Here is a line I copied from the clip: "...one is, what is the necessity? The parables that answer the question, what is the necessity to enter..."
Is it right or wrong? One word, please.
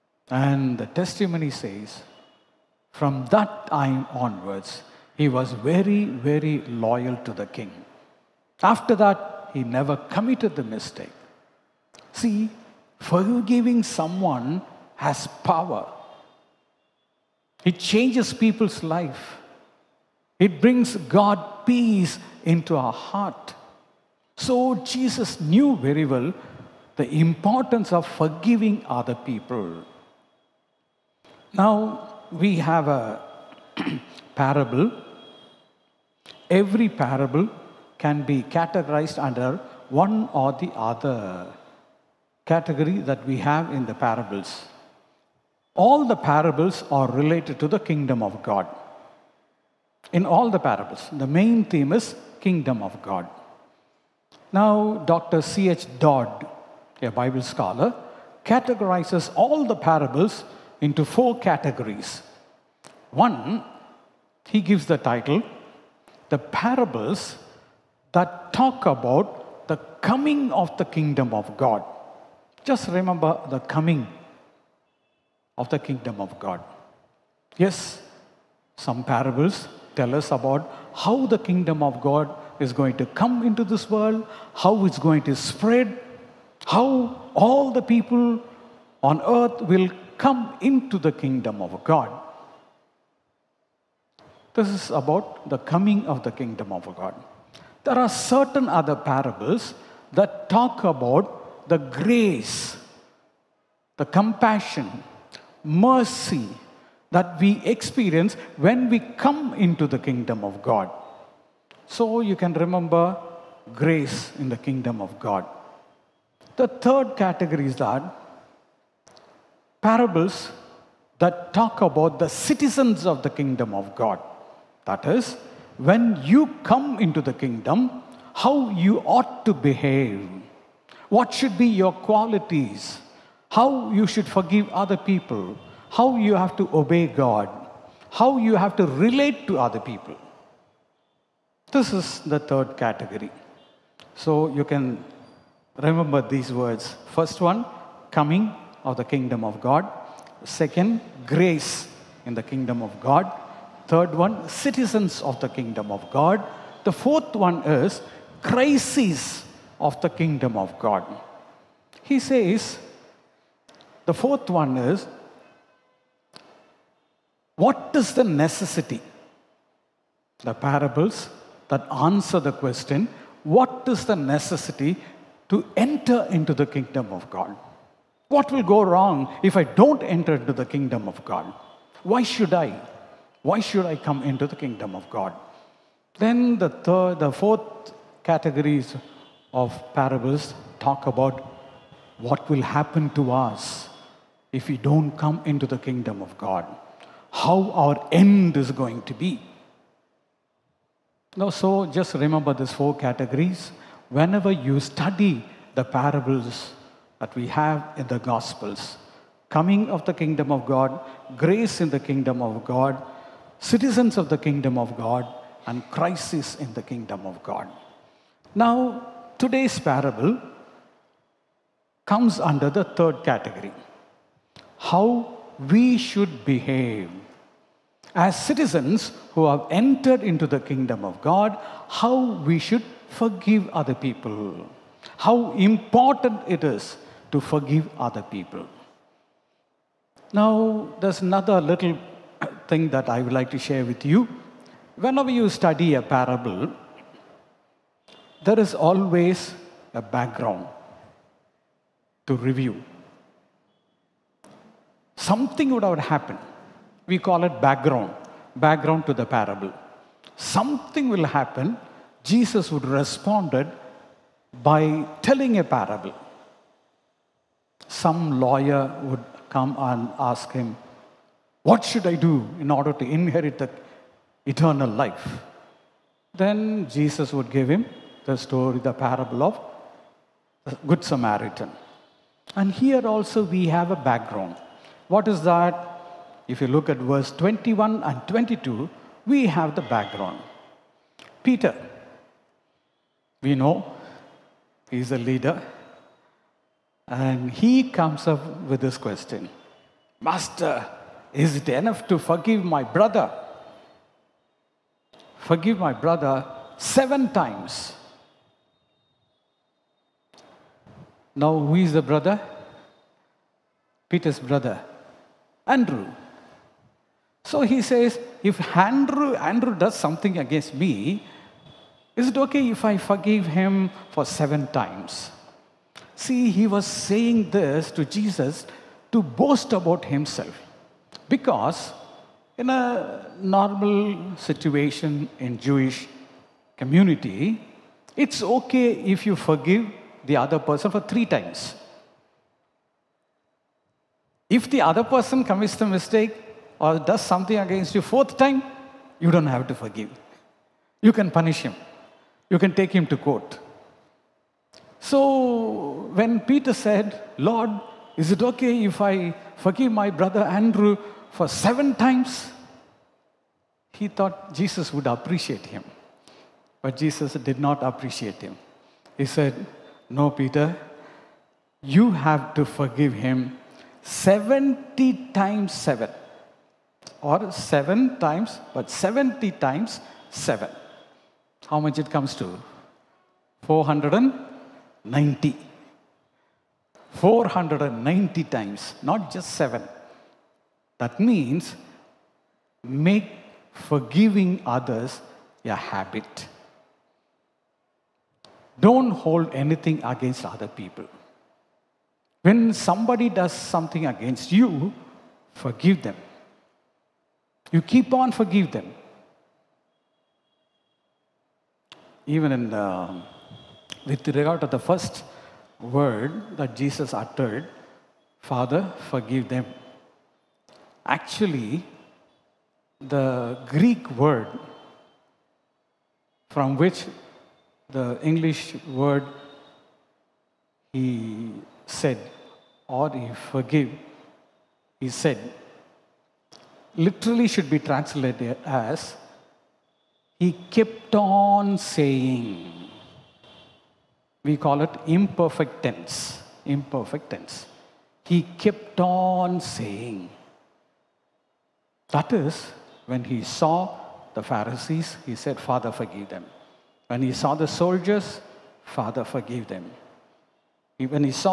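right.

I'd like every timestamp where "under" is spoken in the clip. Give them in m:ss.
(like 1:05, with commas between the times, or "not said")
0:39, 3:42.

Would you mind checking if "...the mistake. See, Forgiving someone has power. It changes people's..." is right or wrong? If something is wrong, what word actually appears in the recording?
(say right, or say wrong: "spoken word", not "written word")
right.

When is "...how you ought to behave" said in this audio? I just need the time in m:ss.
2:08.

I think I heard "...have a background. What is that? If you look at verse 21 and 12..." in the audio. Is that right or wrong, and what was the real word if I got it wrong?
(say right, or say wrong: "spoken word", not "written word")
wrong: "22", not "12".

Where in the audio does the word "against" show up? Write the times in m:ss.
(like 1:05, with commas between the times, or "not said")
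5:20, 5:47, 6:40, 6:44.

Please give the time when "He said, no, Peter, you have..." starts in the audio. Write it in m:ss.
6:09.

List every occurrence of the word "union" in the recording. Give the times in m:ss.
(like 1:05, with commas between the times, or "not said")
not said.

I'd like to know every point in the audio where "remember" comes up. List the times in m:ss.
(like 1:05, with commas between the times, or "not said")
1:12, 1:52, 2:25, 3:22.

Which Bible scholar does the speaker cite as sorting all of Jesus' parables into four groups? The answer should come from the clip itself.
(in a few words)
C.H. Dodd.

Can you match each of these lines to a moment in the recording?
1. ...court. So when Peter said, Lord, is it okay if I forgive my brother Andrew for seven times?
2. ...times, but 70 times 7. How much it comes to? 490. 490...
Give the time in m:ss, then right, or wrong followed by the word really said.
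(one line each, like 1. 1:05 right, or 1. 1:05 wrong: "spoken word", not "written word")
1. 5:53 right
2. 6:18 right.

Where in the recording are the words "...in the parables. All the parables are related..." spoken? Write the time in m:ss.
0:43.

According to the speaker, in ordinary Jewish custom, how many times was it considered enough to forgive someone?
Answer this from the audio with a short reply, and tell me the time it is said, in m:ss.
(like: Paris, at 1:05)
3, at 5:40.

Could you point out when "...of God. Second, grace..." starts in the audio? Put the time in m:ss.
2:29.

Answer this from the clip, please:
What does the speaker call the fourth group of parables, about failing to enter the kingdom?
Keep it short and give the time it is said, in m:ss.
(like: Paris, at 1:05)
Crises of the kingdom of God, at 2:38.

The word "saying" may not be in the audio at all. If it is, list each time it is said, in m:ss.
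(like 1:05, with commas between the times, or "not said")
5:26, 7:21, 7:29.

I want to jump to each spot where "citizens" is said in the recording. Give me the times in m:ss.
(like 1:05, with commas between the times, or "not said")
2:02, 2:34, 3:33, 3:48.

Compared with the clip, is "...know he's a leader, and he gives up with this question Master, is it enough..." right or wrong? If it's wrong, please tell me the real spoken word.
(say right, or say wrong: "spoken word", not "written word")
wrong: "comes", not "gives".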